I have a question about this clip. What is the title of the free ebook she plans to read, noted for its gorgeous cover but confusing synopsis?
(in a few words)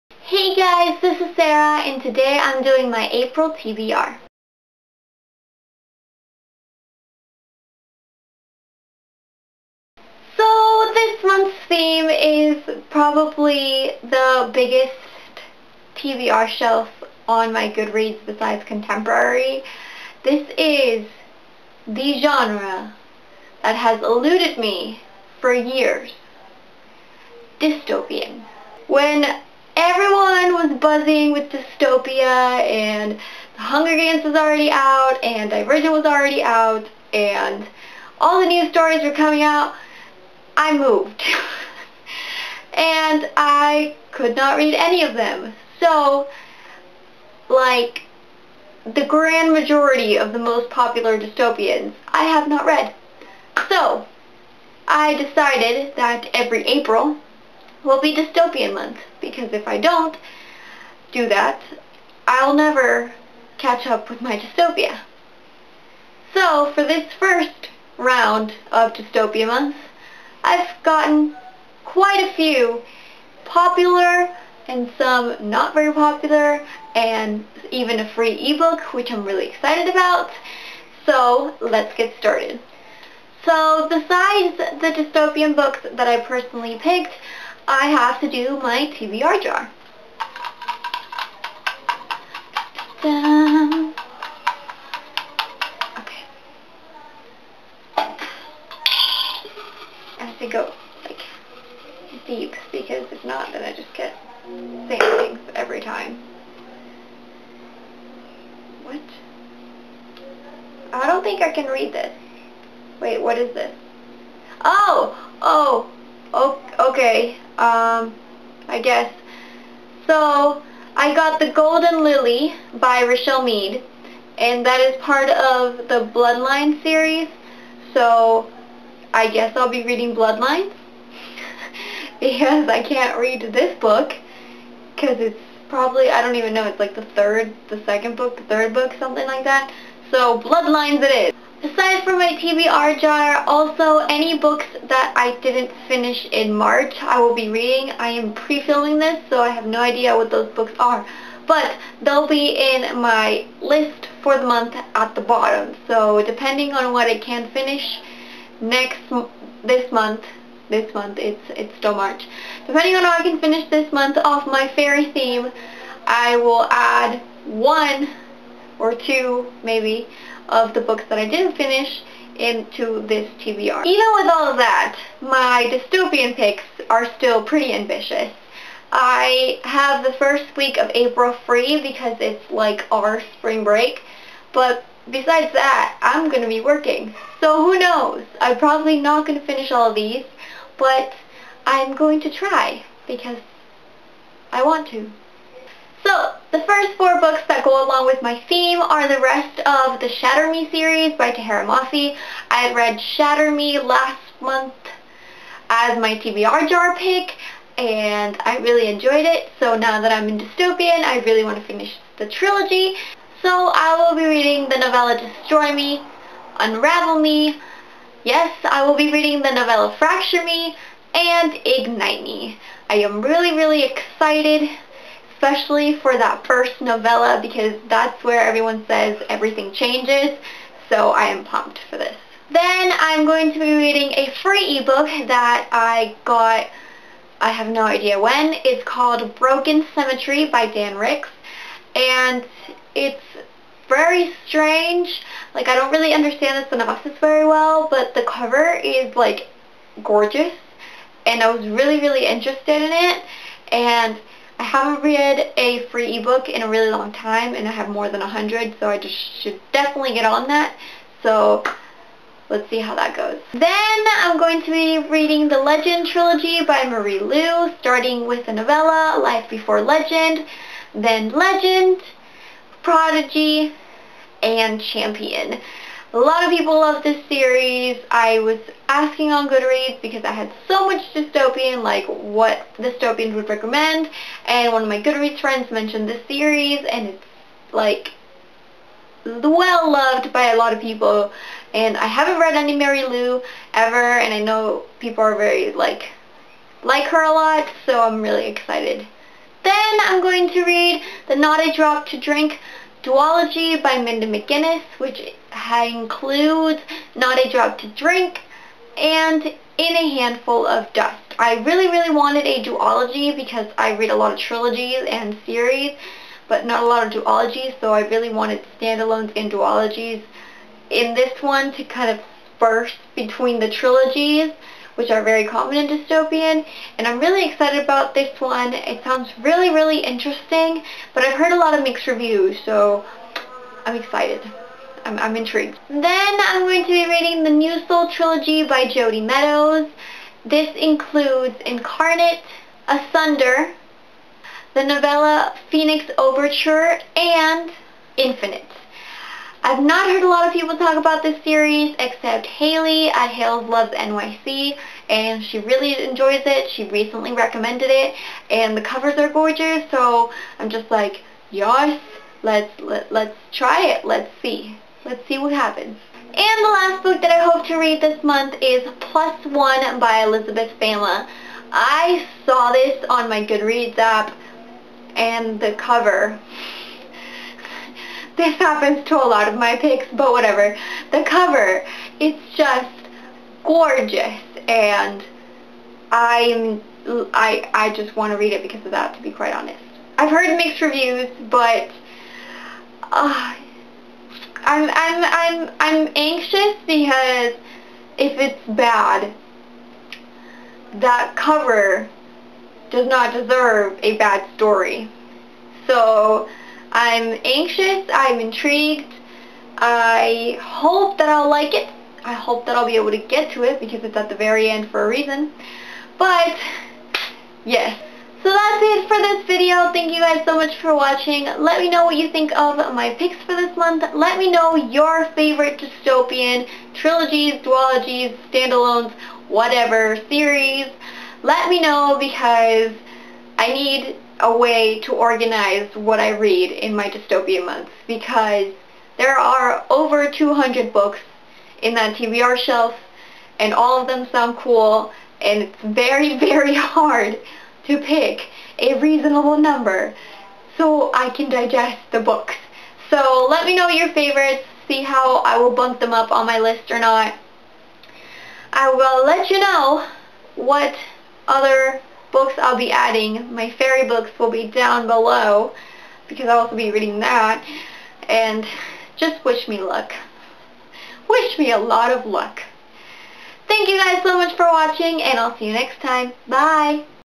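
Broken Symmetry.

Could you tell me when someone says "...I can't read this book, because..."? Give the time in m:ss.
2:12.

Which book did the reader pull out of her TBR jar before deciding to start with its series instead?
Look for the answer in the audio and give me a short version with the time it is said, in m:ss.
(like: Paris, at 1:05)
The Golden Lily, at 2:01.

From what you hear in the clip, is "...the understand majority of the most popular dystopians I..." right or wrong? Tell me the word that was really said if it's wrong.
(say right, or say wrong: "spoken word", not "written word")
wrong: "grand", not "understand".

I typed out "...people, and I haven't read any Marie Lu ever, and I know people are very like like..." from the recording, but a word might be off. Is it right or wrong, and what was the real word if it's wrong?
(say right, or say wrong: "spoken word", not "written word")
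right.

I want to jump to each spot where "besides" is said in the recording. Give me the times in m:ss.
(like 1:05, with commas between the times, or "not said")
0:18, 1:23, 3:05.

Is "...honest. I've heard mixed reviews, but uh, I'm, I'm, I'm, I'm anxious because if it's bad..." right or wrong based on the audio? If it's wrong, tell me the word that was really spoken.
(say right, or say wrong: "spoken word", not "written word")
right.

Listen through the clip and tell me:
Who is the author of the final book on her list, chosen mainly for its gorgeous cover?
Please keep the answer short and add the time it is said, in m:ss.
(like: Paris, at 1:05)
Elizabeth Fama, at 6:10.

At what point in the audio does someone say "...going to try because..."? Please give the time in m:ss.
3:11.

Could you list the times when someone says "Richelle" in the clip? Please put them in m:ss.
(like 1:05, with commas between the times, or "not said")
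2:03.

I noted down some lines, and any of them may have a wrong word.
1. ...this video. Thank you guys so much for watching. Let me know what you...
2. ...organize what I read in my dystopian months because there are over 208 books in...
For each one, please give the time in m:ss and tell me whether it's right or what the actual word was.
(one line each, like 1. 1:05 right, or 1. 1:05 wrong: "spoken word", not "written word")
1. 6:59 right
2. 7:15 wrong: "200", not "208".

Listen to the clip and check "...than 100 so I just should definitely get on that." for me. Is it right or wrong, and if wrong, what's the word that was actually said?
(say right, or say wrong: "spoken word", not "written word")
right.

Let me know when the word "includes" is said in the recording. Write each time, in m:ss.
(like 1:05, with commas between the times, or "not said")
5:05, 5:40.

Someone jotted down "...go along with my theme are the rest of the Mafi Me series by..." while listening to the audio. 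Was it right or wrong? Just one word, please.
wrong.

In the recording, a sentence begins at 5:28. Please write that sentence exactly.
It sounds really, really interesting, but I've heard a lot of mixed reviews, so I'm excited.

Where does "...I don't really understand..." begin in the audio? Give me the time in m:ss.
4:05.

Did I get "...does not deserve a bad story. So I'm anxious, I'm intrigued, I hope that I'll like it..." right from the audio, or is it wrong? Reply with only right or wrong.
right.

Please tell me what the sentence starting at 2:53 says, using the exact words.
Even with all of that, my dystopian picks are still pretty ambitious.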